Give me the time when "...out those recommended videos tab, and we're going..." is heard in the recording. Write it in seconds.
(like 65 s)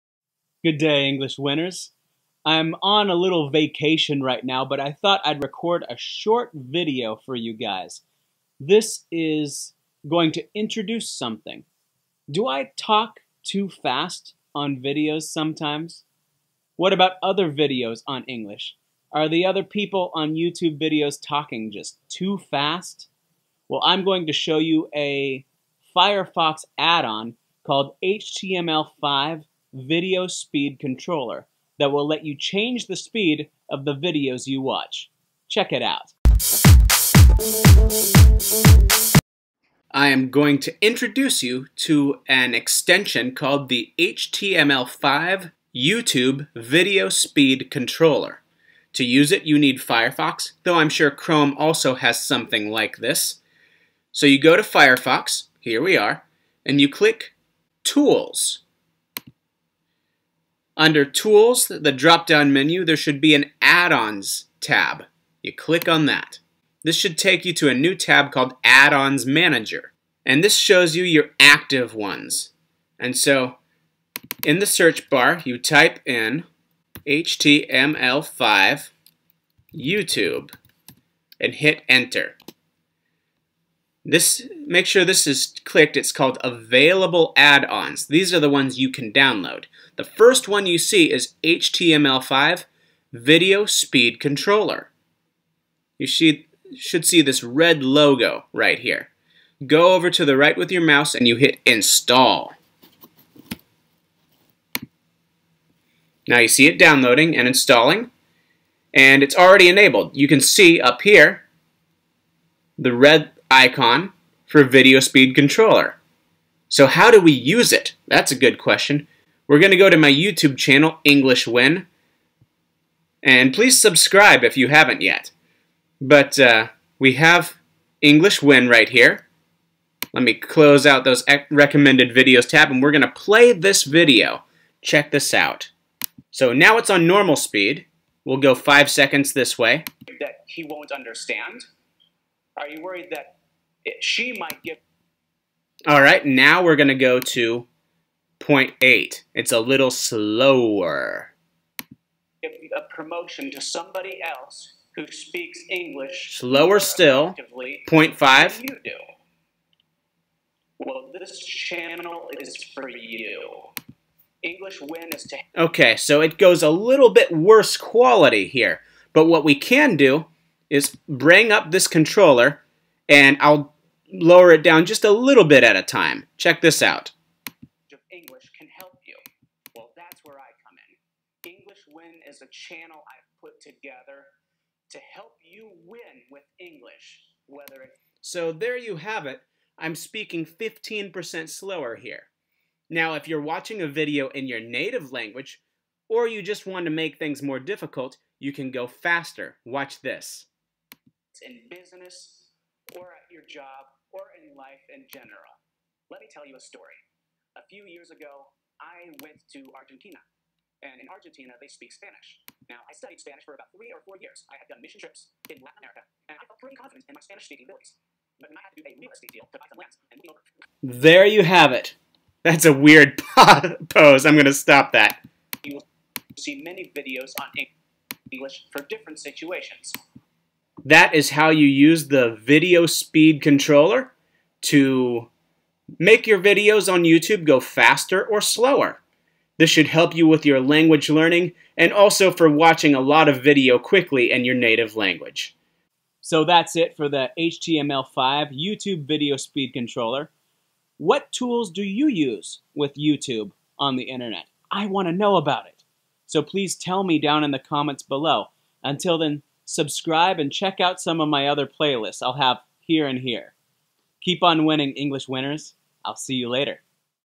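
130 s.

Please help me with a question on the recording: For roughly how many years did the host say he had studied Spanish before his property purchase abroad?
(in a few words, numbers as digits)
3 or 4 years.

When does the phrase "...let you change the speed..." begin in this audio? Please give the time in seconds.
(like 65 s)
32 s.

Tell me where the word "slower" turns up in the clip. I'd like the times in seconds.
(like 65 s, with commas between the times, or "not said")
149 s, 156 s, 191 s, 238 s.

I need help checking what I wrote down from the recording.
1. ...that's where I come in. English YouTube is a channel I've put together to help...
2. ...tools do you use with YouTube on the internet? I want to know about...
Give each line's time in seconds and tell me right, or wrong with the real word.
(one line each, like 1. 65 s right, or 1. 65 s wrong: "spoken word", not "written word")
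1. 179 s wrong: "Win", not "YouTube"
2. 251 s right.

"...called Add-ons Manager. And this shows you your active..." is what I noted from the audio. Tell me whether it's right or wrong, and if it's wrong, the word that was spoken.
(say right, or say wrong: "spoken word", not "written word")
right.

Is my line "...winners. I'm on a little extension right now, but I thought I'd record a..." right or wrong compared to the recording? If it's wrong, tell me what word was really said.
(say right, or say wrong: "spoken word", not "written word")
wrong: "vacation", not "extension".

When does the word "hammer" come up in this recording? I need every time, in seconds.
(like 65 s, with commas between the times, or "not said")
not said.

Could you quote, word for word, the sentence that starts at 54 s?
So you go to Firefox, here we are, and you click Tools.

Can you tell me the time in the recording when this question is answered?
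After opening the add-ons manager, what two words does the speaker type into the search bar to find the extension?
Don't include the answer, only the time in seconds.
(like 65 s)
75 s.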